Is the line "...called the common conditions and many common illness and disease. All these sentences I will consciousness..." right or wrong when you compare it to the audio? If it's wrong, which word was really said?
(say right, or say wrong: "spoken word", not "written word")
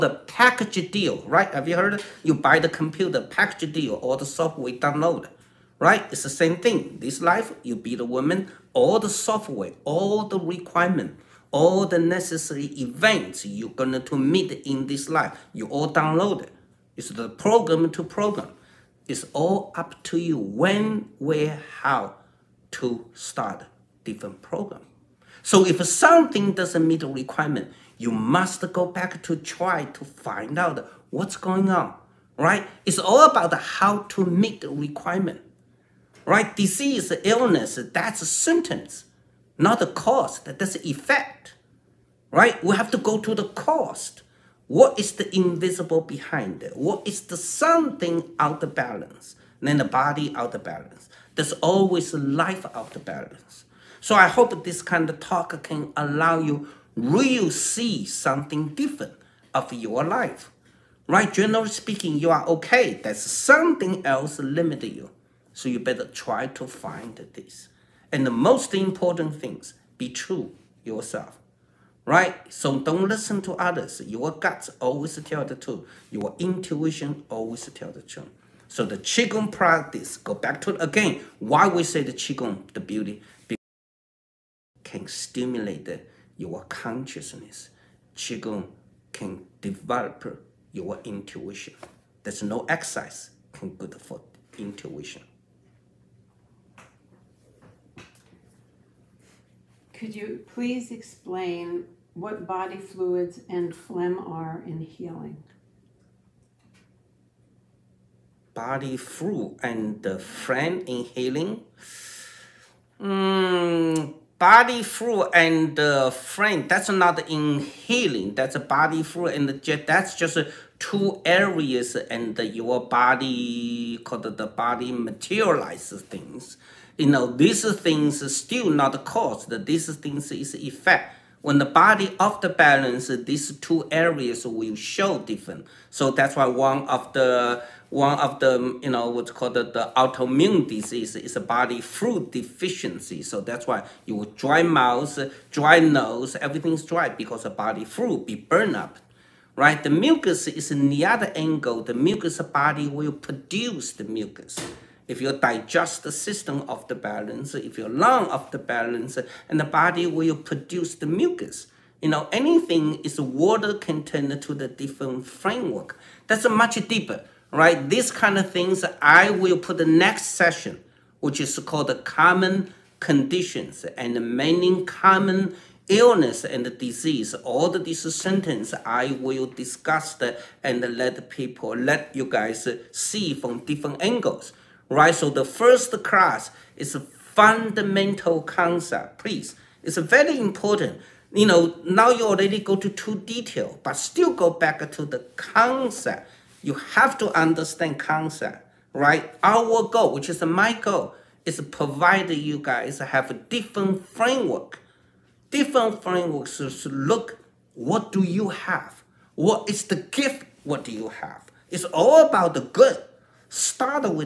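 wrong: "discuss", not "consciousness".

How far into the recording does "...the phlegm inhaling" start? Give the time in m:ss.
1:50.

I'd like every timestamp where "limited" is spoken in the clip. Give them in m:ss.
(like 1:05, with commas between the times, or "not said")
1:04.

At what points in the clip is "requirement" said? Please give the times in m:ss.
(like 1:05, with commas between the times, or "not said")
0:10, 0:27, 0:34.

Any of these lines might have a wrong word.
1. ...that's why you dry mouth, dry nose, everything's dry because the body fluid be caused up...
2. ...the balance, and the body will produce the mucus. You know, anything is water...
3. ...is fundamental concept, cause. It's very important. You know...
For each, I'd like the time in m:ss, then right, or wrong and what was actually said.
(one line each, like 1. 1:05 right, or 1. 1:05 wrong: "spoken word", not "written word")
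1. 2:23 wrong: "burned", not "caused"
2. 2:38 right
3. 3:06 wrong: "please", not "cause".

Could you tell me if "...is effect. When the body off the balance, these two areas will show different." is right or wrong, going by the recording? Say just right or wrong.
right.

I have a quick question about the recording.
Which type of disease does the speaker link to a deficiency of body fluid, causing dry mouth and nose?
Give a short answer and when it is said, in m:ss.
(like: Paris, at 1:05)
autoimmune disease, at 2:19.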